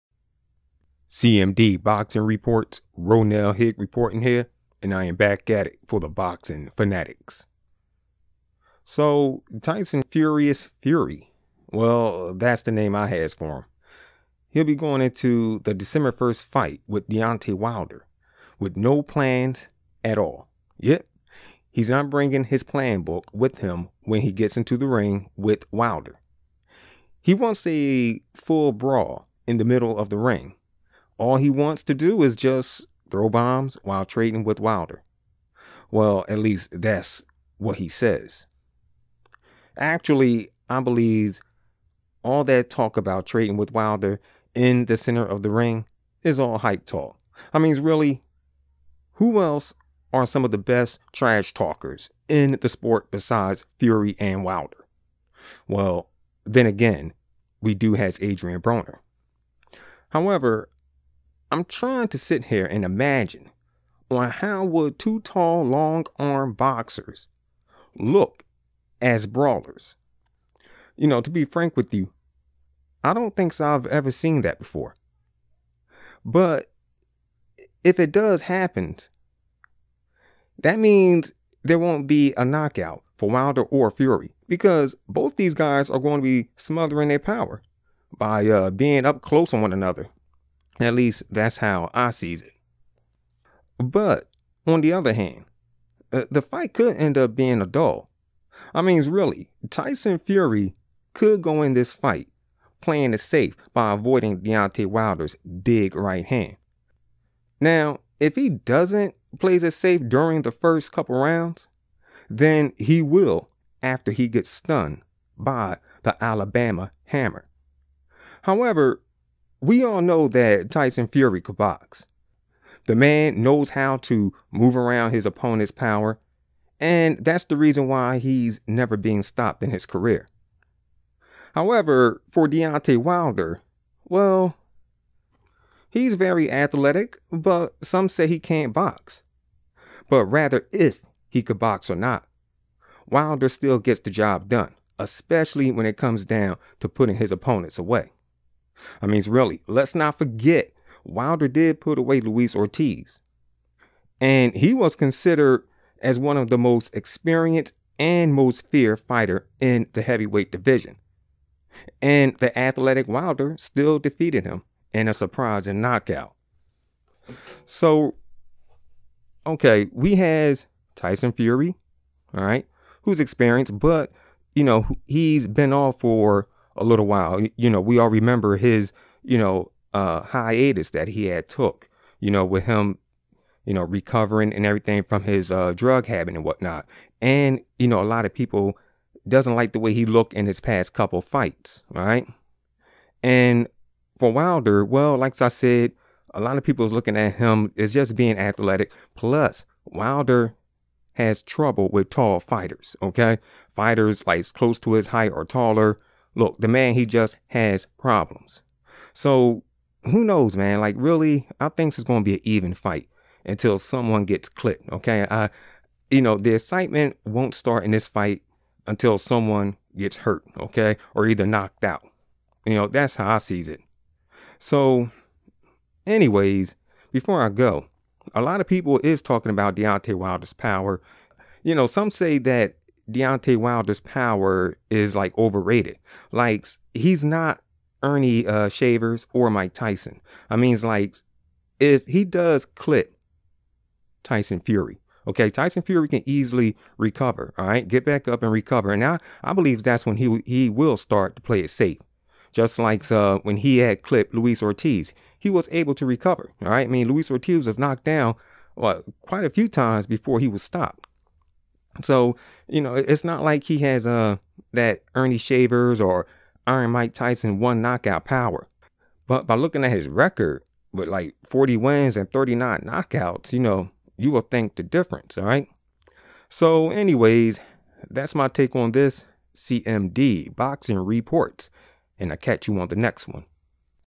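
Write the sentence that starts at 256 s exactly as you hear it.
All right, I mean Luis Ortiz was knocked down well, quite a few times before he was stopped.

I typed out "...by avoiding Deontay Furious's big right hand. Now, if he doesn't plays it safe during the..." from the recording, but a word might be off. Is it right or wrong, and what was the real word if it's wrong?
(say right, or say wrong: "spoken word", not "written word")
wrong: "Wilder", not "Furious".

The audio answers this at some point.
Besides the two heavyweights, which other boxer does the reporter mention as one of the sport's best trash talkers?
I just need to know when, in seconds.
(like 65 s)
58 s.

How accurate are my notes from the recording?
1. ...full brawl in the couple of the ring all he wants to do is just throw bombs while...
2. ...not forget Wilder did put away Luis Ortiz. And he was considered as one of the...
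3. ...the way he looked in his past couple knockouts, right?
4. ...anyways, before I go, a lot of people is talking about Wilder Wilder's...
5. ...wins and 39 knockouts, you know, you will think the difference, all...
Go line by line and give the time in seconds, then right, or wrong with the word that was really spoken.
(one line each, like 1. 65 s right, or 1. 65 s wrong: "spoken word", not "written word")
1. 28 s wrong: "middle", not "couple"
2. 149 s right
3. 189 s wrong: "fights", not "knockouts"
4. 226 s wrong: "Deontay", not "Wilder"
5. 271 s right.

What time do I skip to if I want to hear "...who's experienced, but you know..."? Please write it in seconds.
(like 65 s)
173 s.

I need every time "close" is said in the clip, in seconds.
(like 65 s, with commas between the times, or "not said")
89 s, 204 s.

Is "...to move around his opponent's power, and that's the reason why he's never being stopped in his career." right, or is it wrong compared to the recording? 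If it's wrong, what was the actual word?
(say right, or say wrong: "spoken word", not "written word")
right.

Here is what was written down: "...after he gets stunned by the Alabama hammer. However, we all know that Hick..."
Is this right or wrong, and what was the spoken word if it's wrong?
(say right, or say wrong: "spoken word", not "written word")
wrong: "Tyson", not "Hick".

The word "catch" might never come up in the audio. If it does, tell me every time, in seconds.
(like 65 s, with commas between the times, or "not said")
282 s.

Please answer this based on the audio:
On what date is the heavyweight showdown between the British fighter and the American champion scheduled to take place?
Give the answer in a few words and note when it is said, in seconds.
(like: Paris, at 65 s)
December 1st, at 15 s.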